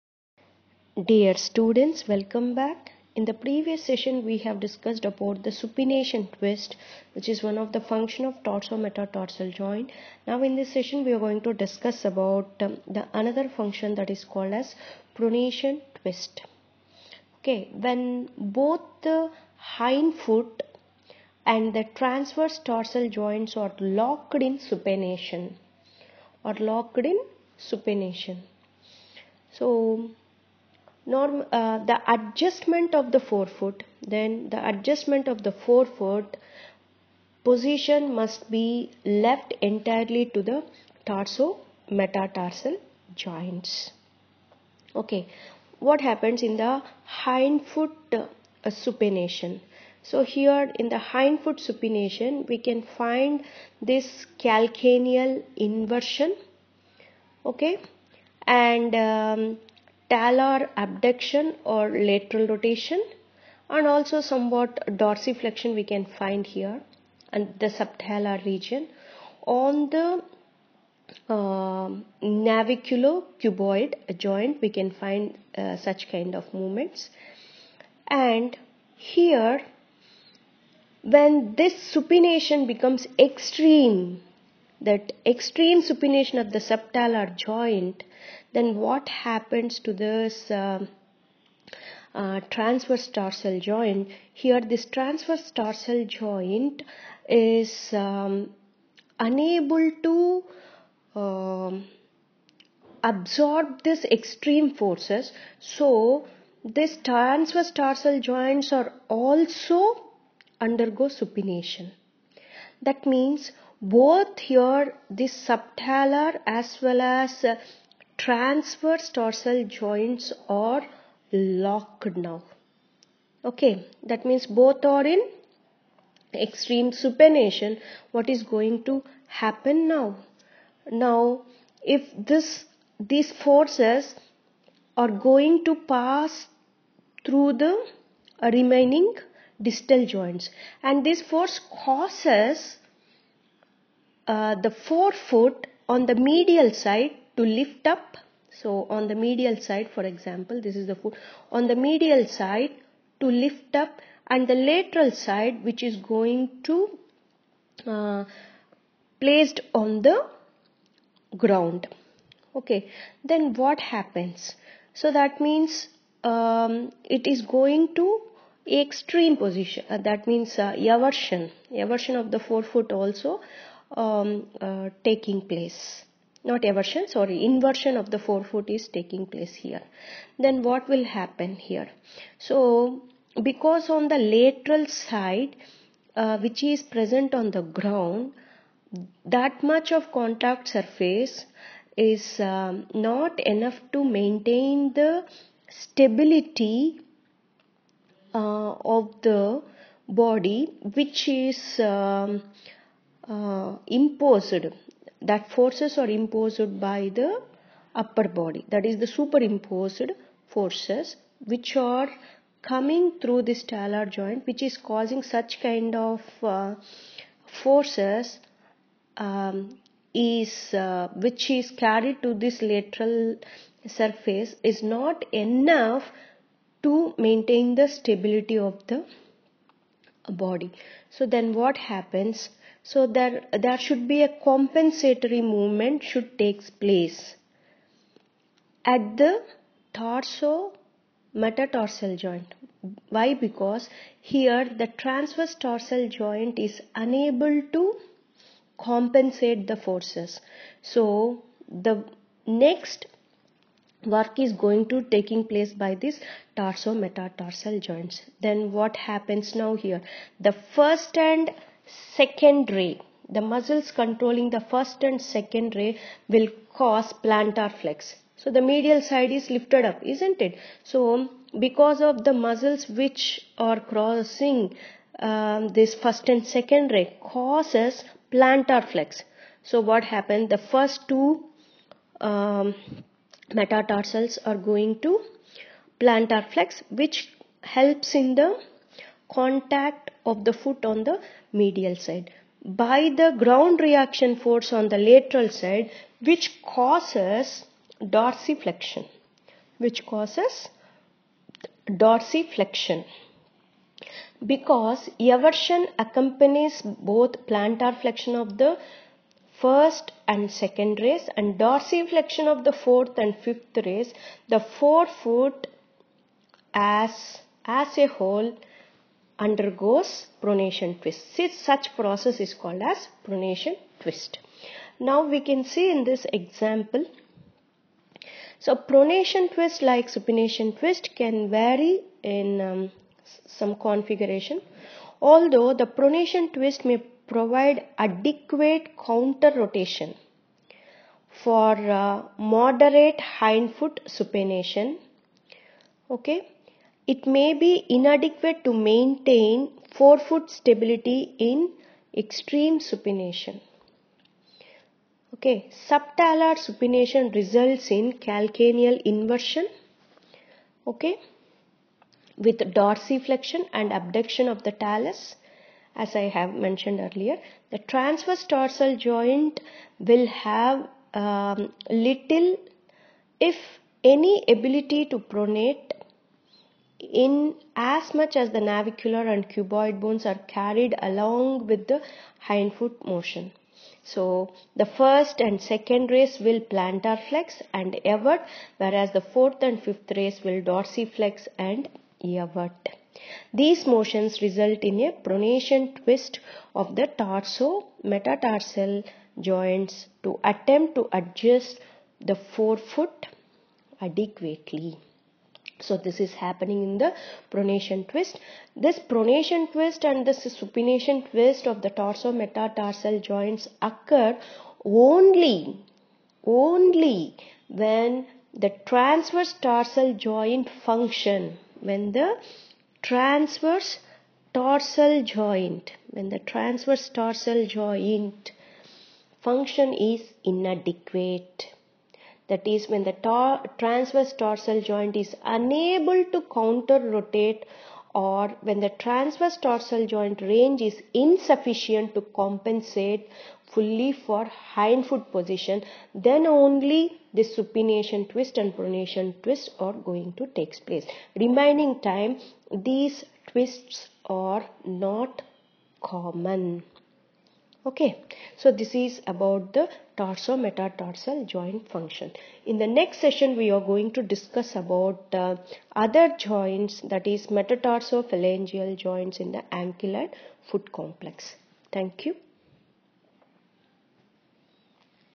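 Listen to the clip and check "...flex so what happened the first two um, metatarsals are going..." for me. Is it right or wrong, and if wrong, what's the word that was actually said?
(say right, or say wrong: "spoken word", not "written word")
right.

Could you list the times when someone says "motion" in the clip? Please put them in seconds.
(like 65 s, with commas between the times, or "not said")
383 s, 393 s.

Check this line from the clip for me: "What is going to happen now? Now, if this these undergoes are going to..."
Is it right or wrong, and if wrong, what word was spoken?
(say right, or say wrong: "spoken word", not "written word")
wrong: "forces", not "undergoes".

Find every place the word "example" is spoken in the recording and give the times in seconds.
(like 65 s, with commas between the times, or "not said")
150 s, 326 s.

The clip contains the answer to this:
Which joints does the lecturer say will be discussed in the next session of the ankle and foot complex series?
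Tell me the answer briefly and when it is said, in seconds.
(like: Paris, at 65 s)
Metatarsophalangeal joints, at 467 s.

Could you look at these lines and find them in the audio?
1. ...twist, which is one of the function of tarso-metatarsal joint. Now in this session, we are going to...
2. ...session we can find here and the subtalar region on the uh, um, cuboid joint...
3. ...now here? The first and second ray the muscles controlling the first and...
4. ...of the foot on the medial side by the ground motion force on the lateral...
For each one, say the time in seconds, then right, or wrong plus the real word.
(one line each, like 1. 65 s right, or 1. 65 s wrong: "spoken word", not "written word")
1. 6 s right
2. 65 s wrong: "dorsiflexion", not "session"
3. 259 s right
4. 290 s wrong: "reaction", not "motion".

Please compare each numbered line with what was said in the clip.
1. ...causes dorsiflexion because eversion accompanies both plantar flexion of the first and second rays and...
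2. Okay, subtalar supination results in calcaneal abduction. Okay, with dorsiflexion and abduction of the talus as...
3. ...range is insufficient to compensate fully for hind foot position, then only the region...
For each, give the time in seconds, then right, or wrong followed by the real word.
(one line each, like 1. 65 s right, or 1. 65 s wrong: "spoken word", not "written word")
1. 300 s right
2. 355 s wrong: "inversion", not "abduction"
3. 440 s wrong: "supination", not "region".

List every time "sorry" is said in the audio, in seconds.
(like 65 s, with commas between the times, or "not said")
177 s.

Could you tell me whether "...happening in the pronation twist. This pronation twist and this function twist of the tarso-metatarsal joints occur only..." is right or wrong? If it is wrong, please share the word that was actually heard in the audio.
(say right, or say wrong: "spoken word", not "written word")
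wrong: "supination", not "function".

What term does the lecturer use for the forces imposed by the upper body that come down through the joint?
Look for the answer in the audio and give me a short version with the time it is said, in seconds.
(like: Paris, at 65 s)
Superimposed forces, at 209 s.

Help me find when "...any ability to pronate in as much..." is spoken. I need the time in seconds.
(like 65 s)
374 s.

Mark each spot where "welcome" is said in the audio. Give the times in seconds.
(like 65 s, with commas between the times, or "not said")
2 s.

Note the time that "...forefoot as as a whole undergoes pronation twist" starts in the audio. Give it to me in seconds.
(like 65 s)
314 s.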